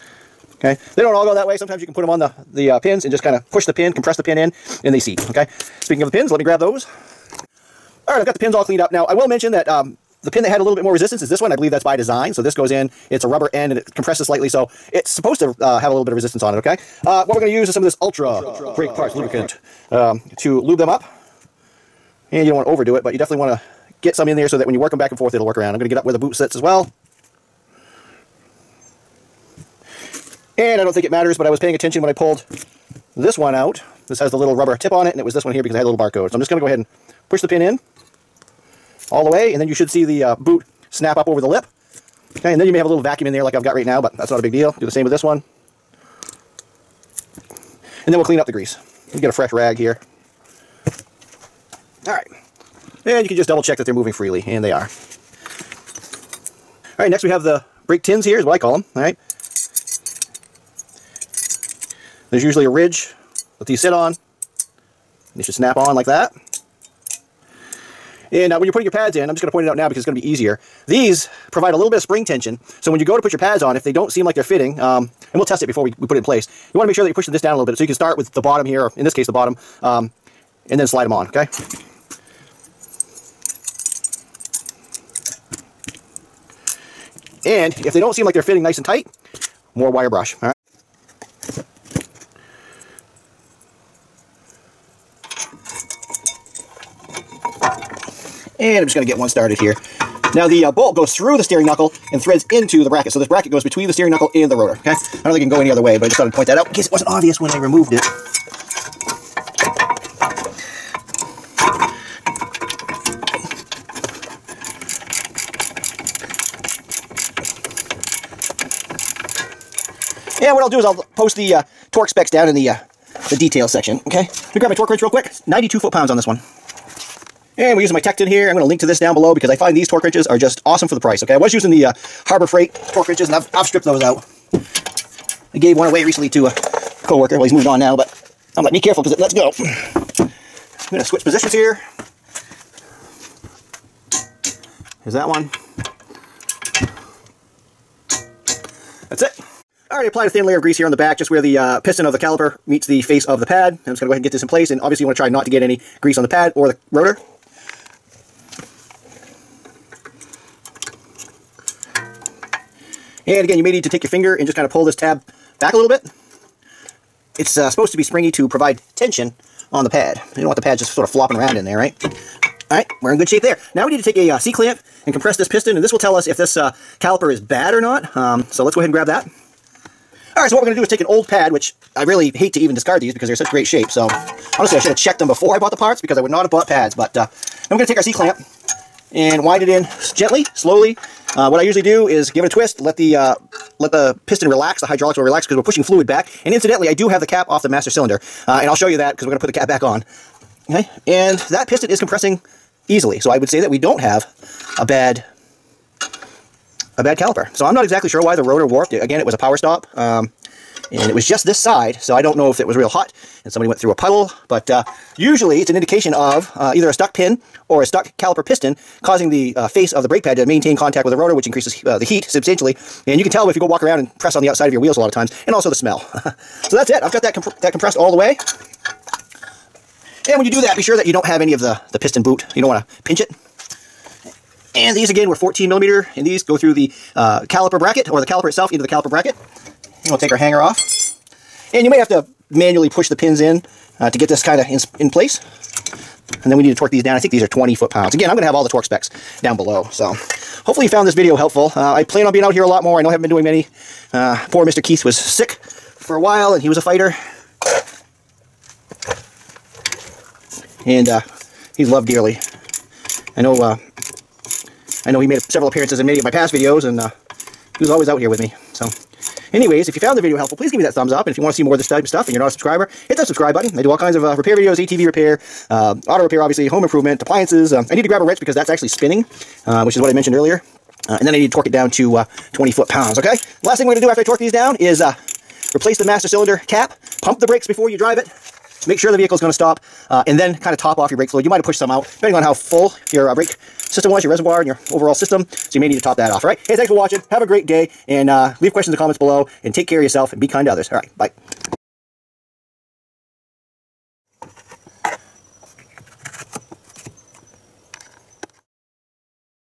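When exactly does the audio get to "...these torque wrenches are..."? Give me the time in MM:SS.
02:09.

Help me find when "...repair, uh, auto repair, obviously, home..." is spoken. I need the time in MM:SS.
04:35.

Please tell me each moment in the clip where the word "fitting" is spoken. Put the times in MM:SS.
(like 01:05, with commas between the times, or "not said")
01:14, 01:28.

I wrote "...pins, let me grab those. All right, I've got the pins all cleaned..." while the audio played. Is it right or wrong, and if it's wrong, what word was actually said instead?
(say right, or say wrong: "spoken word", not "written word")
right.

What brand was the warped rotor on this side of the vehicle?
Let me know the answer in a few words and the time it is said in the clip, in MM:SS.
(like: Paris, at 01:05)
Power Stop, at 03:29.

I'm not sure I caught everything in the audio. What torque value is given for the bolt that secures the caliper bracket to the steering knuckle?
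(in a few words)
92 foot-pounds.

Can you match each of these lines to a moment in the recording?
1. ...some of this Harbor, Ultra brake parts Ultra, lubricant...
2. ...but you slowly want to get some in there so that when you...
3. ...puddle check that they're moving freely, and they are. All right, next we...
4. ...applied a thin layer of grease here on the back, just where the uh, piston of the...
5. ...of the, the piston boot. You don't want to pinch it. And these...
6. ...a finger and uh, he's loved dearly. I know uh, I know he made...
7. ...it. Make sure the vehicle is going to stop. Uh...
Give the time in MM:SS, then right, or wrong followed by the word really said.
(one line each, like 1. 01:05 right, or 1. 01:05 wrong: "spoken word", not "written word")
1. 00:17 wrong: "Ultra", not "Harbor"
2. 00:23 wrong: "definitely", not "slowly"
3. 00:53 wrong: "double", not "puddle"
4. 02:30 right
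5. 03:51 right
6. 04:16 wrong: "fighter", not "finger"
7. 04:48 right.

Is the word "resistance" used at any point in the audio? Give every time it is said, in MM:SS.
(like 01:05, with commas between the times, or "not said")
00:10, 00:16.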